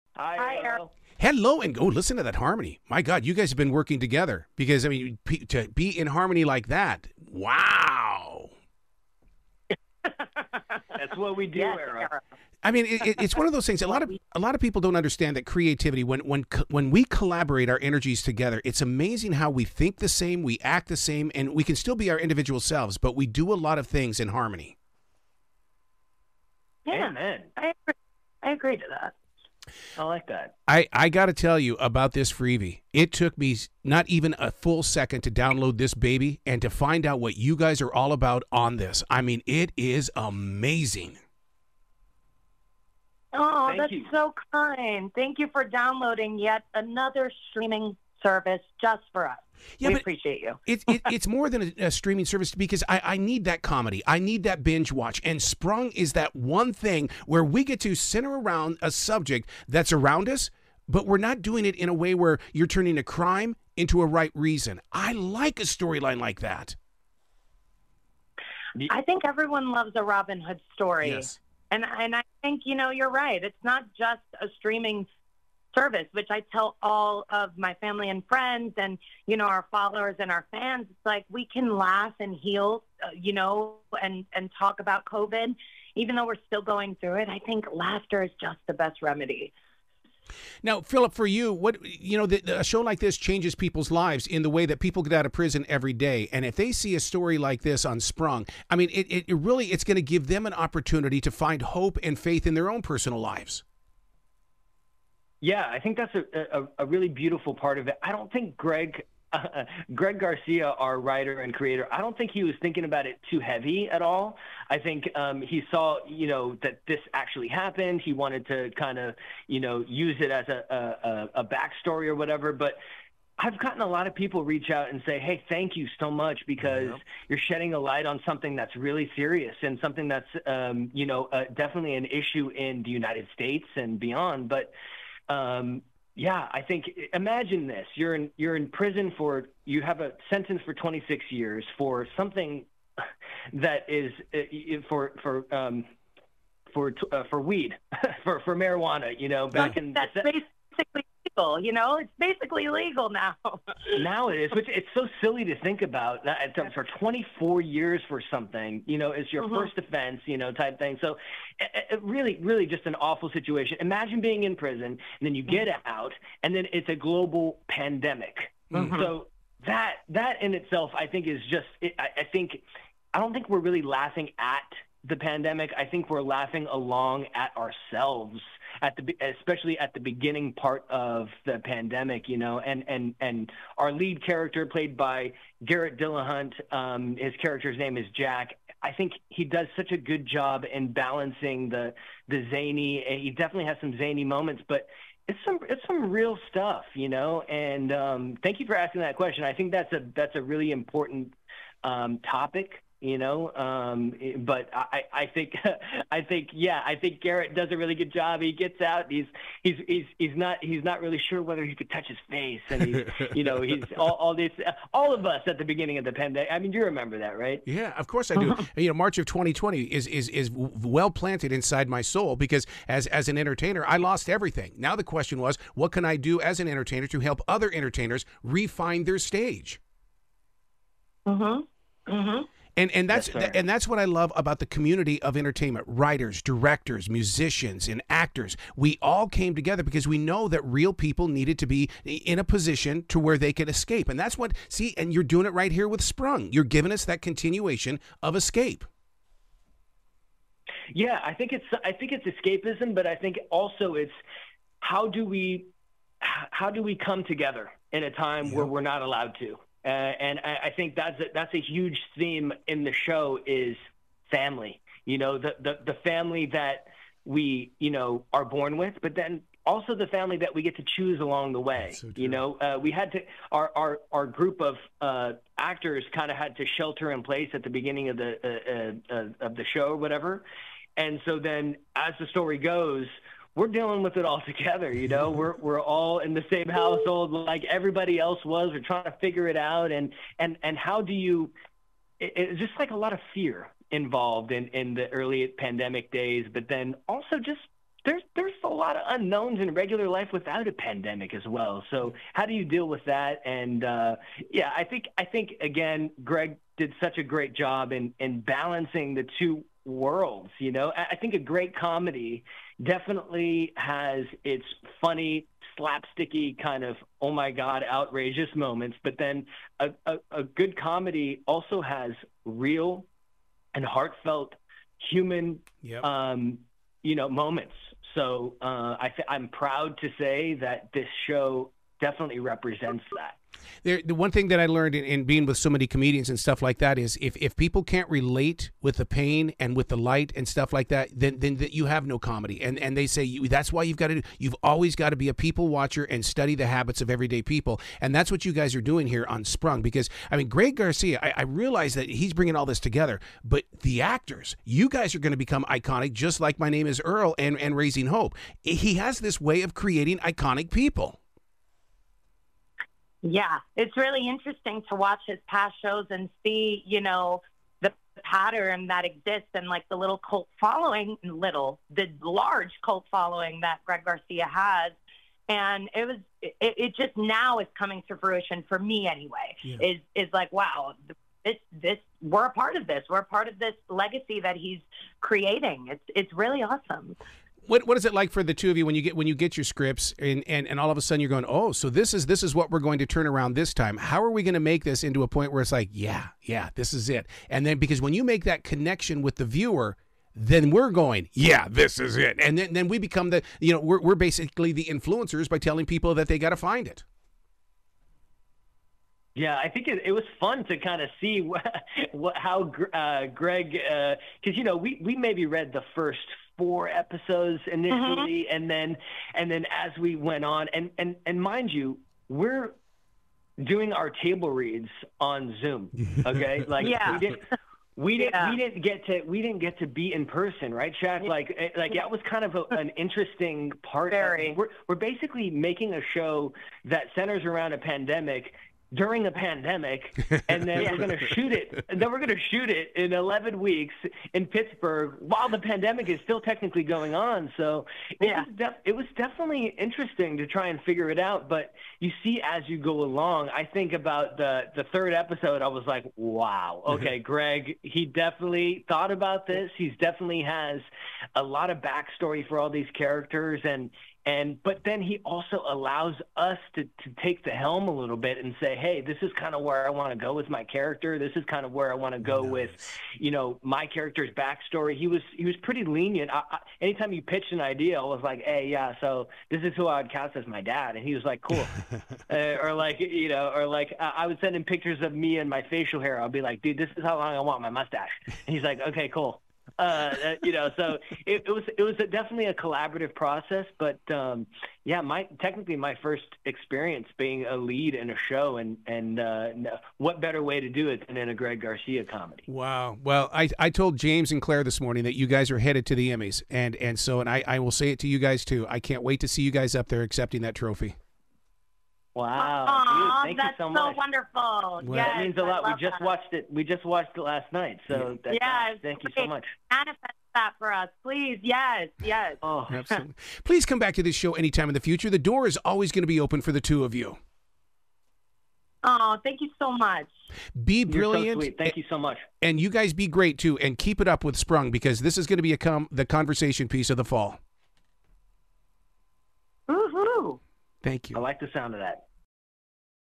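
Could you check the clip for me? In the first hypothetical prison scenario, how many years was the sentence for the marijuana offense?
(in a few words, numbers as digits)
26.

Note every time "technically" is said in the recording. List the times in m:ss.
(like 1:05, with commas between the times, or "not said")
7:26, 8:15.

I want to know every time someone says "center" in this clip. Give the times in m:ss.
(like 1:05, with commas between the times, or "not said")
0:57, 7:17.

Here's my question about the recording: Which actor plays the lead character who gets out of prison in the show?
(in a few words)
Garrett Dillahunt.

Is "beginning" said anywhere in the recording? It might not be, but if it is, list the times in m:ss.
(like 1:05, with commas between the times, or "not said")
2:59, 3:35, 4:37.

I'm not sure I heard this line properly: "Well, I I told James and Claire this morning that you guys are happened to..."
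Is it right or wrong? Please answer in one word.
wrong.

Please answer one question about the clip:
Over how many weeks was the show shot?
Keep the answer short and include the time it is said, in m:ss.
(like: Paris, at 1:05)
11, at 7:23.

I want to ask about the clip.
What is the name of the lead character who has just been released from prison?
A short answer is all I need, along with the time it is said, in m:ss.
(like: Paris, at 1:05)
Jack, at 3:08.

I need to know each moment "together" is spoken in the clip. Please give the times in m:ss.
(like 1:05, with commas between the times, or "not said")
0:03, 0:18, 3:59, 4:17, 4:44, 5:52.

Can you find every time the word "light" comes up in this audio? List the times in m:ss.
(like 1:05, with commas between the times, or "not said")
2:07, 5:39.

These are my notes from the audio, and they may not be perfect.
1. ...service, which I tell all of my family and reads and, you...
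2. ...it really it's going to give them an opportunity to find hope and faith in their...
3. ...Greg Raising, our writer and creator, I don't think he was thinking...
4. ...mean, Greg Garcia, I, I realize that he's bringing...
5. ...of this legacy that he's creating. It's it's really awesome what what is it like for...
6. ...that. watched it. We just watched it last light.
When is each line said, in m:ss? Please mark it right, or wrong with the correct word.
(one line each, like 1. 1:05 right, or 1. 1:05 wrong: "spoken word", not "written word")
1. 1:15 wrong: "friends", not "reads"
2. 1:39 right
3. 1:49 wrong: "Garcia", not "Raising"
4. 5:50 right
5. 6:23 right
6. 8:35 wrong: "night", not "light".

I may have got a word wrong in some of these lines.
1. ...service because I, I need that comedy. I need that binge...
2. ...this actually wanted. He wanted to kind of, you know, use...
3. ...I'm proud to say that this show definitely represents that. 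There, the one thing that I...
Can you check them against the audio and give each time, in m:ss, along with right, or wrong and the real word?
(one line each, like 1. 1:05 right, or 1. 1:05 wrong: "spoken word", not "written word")
1. 0:52 right
2. 1:56 wrong: "happened", not "wanted"
3. 5:29 right.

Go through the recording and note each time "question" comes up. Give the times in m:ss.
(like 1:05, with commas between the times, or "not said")
3:19, 3:45.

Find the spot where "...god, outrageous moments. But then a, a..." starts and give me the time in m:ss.
5:17.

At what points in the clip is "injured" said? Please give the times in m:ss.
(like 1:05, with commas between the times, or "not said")
not said.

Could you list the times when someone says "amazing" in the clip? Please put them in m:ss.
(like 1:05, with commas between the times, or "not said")
0:18, 0:40.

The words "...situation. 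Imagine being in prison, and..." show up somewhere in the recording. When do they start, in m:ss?
2:43.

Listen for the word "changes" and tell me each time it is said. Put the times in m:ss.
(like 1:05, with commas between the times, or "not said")
1:33.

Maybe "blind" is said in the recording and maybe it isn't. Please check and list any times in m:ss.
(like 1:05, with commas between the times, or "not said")
not said.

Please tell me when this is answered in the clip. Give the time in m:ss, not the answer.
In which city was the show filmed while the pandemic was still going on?
7:24.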